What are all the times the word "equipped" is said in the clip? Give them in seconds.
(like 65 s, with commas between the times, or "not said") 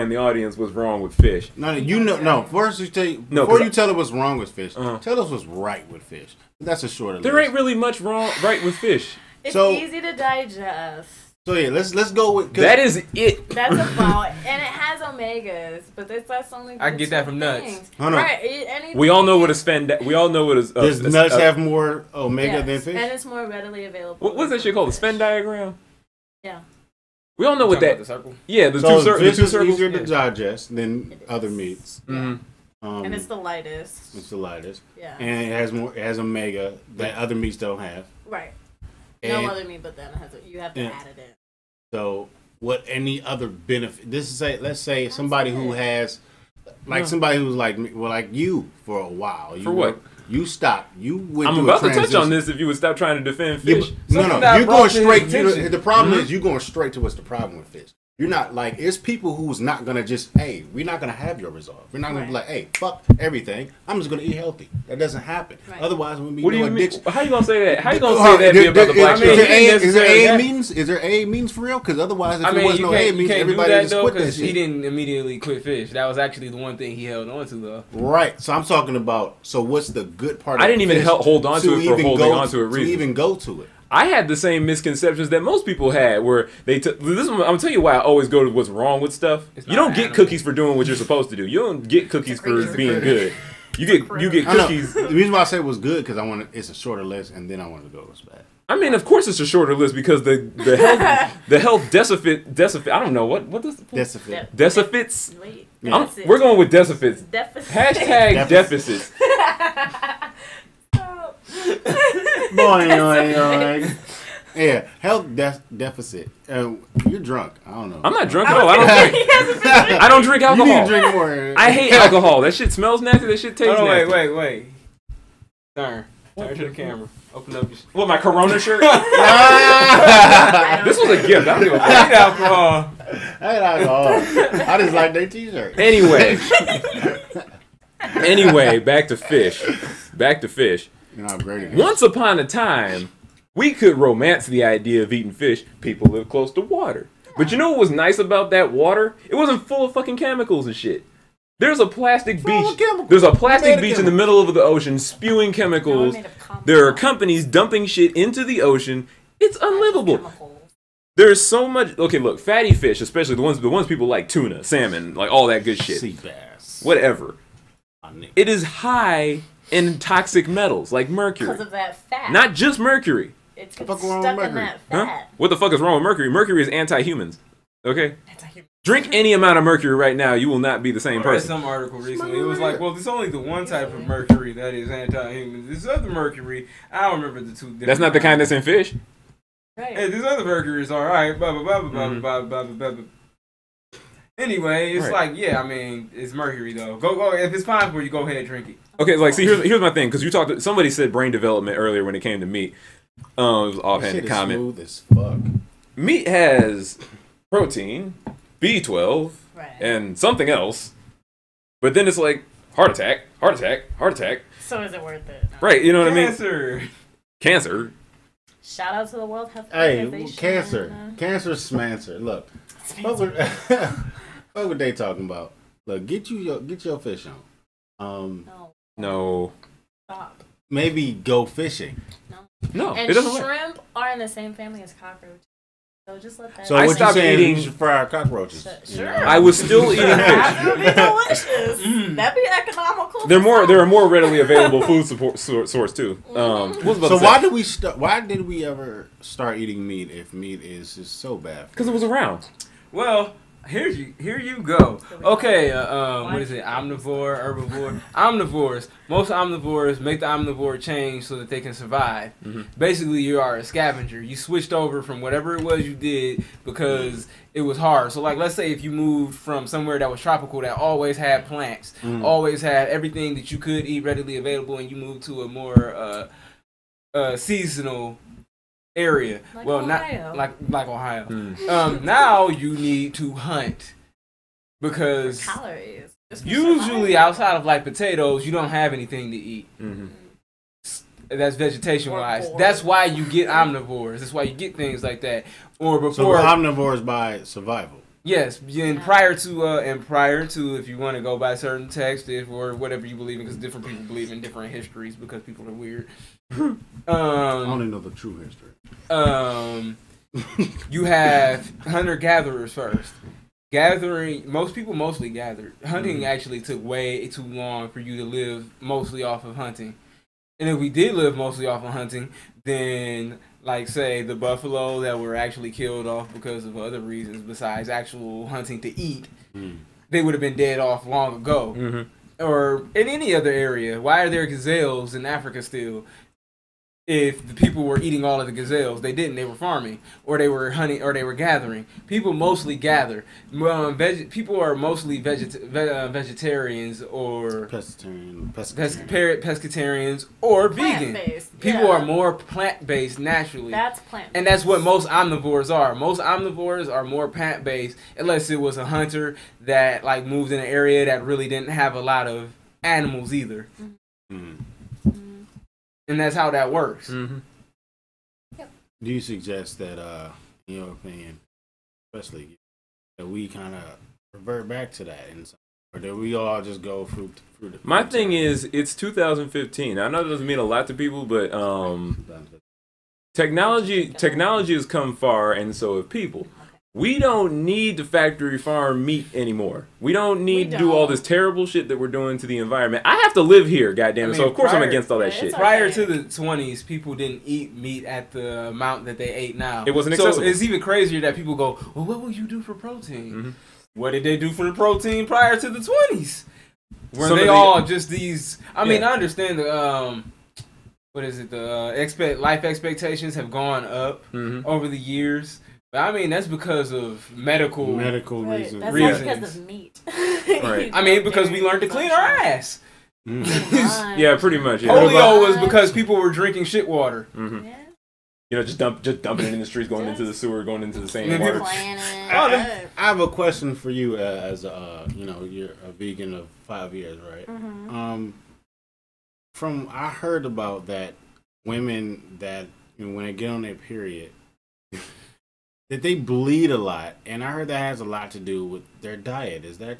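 not said.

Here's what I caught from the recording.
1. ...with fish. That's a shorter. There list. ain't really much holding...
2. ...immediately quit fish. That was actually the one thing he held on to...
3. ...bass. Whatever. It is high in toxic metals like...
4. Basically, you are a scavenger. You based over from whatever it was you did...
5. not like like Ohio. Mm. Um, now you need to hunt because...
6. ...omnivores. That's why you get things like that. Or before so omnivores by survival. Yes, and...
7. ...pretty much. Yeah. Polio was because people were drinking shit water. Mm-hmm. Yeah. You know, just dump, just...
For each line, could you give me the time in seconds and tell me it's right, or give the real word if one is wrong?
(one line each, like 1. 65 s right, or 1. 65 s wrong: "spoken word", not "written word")
1. 5 s wrong: "wrong", not "holding"
2. 74 s right
3. 166 s right
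4. 262 s wrong: "switched", not "based"
5. 280 s right
6. 293 s right
7. 424 s right.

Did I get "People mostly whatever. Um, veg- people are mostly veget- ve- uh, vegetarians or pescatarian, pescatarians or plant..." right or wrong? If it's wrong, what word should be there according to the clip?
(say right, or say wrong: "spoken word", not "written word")
wrong: "gather", not "whatever".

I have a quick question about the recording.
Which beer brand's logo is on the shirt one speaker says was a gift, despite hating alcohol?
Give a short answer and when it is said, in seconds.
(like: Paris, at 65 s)
Corona, at 128 s.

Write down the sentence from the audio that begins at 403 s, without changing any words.
What did they do for the protein prior to the 20s?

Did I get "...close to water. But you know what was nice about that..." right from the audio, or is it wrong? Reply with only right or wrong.
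right.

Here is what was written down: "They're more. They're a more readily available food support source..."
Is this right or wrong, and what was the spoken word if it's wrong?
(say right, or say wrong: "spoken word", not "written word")
right.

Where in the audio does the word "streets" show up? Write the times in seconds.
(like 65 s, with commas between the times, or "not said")
429 s.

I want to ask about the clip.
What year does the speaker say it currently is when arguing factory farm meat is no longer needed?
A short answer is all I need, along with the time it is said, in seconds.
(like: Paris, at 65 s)
2015, at 378 s.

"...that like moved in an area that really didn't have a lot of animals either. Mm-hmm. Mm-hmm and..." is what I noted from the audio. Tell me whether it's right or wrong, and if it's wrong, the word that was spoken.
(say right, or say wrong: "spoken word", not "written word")
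right.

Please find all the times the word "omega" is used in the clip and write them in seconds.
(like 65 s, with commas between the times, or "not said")
14 s, 22 s, 36 s.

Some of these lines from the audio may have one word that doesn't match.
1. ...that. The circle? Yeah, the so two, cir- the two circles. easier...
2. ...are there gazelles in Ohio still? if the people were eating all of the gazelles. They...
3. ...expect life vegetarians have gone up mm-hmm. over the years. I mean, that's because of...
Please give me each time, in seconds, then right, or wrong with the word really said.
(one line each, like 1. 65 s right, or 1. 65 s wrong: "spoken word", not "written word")
1. 27 s right
2. 334 s wrong: "Africa", not "Ohio"
3. 411 s wrong: "expectations", not "vegetarians".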